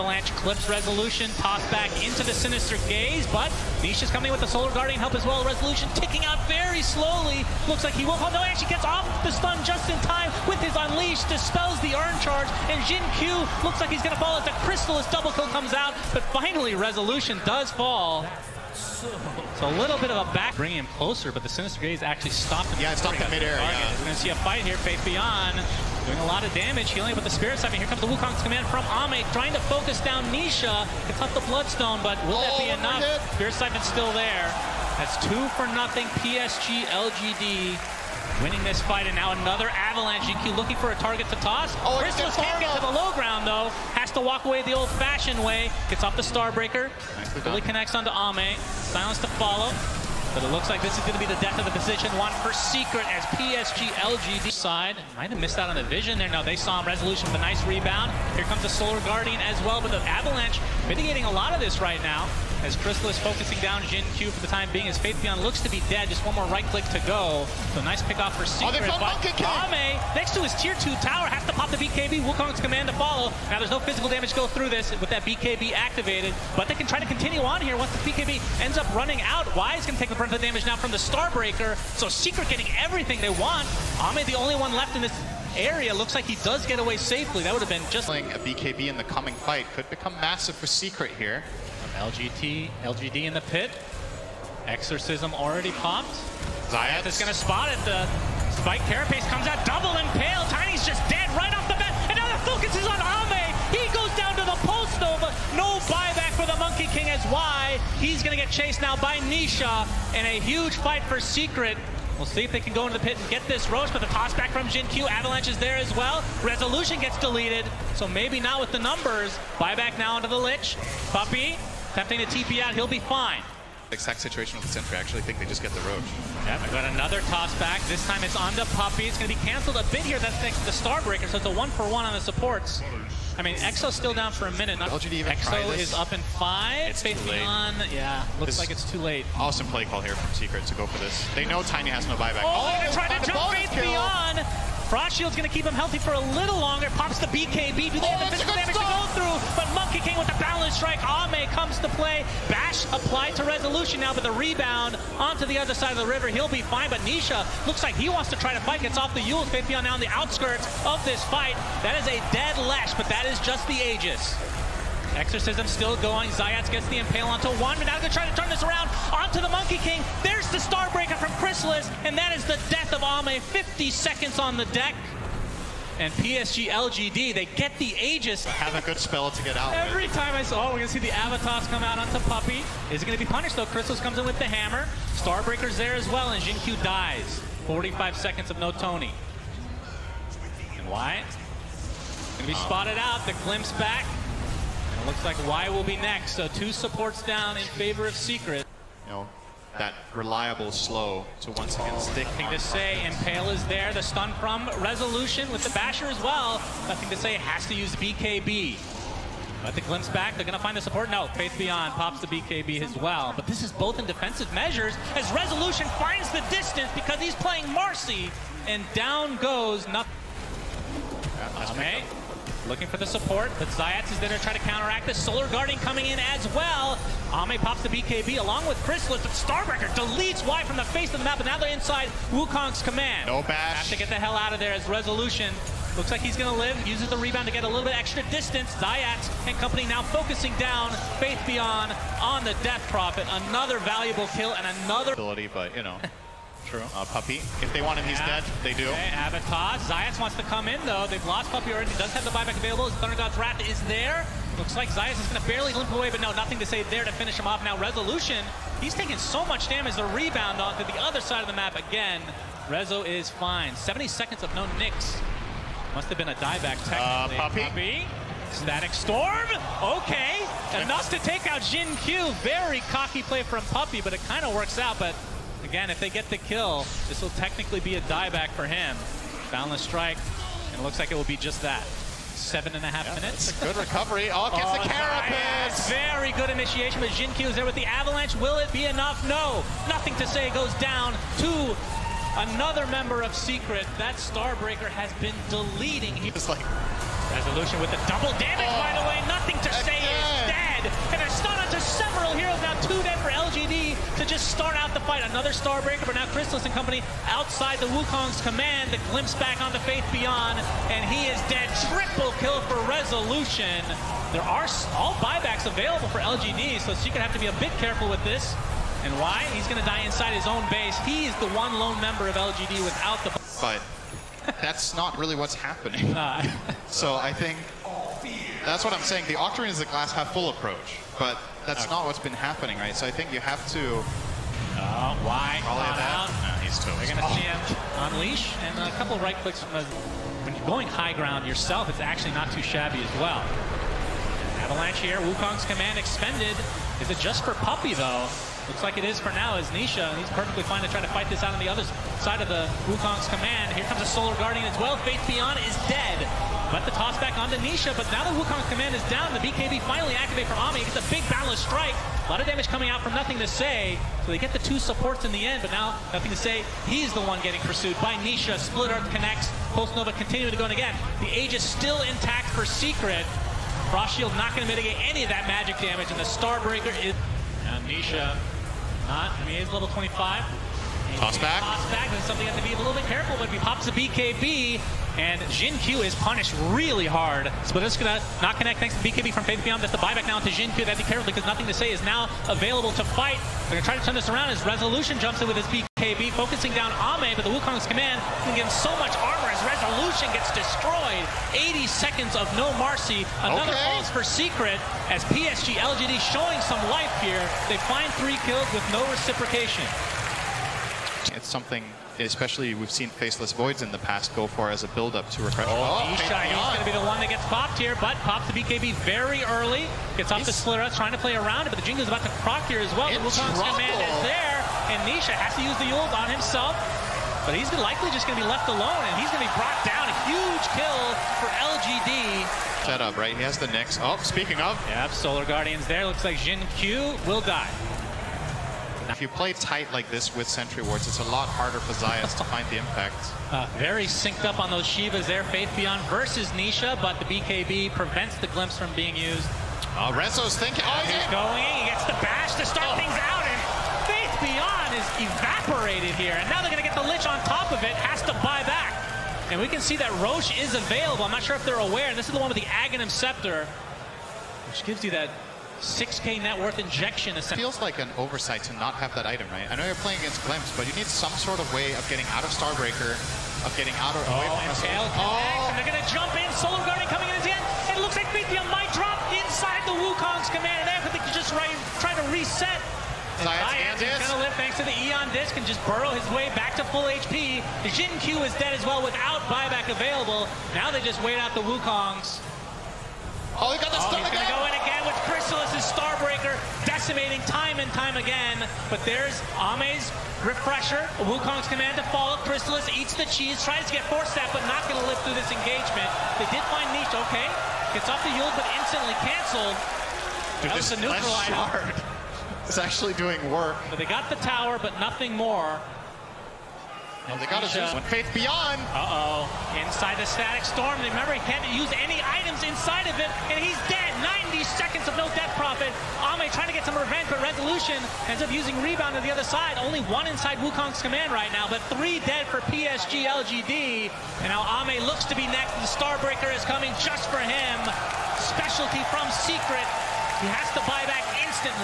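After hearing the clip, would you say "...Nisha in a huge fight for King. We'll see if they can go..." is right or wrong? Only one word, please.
wrong.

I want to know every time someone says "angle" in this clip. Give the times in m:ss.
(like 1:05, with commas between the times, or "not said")
not said.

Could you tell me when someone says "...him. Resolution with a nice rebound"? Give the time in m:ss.
0:56.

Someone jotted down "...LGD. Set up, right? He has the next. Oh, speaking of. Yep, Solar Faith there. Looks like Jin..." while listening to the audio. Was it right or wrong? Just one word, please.
wrong.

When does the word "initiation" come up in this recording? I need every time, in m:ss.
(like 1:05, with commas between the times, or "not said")
4:46.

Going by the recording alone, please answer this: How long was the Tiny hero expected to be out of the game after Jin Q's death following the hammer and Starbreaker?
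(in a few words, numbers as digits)
45 seconds.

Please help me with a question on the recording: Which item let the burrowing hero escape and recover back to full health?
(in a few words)
Aeon Disk.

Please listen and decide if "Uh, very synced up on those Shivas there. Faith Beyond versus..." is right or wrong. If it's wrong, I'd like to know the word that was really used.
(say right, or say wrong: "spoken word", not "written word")
right.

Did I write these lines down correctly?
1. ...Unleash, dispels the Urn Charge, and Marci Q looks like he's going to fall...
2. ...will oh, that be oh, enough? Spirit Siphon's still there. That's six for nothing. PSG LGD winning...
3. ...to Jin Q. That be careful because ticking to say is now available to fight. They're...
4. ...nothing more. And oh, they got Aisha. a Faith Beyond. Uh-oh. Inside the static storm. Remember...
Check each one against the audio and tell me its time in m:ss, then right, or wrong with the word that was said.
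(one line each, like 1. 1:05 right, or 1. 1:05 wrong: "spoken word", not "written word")
1. 0:10 wrong: "Jin", not "Marci"
2. 0:32 wrong: "two", not "six"
3. 6:30 wrong: "nothing", not "ticking"
4. 8:34 right.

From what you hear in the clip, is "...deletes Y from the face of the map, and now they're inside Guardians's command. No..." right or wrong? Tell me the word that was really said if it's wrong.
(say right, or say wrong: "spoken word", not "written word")
wrong: "Wukong", not "Guardians".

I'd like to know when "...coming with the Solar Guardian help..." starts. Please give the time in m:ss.
0:04.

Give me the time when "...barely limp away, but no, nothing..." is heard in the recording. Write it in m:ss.
4:15.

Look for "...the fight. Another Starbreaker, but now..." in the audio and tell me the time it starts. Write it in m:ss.
5:04.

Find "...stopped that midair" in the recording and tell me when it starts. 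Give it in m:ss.
0:22.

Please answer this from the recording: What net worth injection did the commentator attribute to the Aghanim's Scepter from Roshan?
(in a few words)
6K.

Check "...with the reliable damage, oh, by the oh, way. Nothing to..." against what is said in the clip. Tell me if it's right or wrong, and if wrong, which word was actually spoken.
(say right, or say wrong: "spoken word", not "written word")
wrong: "double", not "reliable".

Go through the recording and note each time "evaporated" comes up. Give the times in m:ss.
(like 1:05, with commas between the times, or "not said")
7:35.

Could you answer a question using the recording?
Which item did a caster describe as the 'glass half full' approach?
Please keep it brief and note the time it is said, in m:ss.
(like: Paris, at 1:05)
Octarine, at 5:29.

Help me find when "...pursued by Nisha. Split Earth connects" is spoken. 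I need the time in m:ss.
6:07.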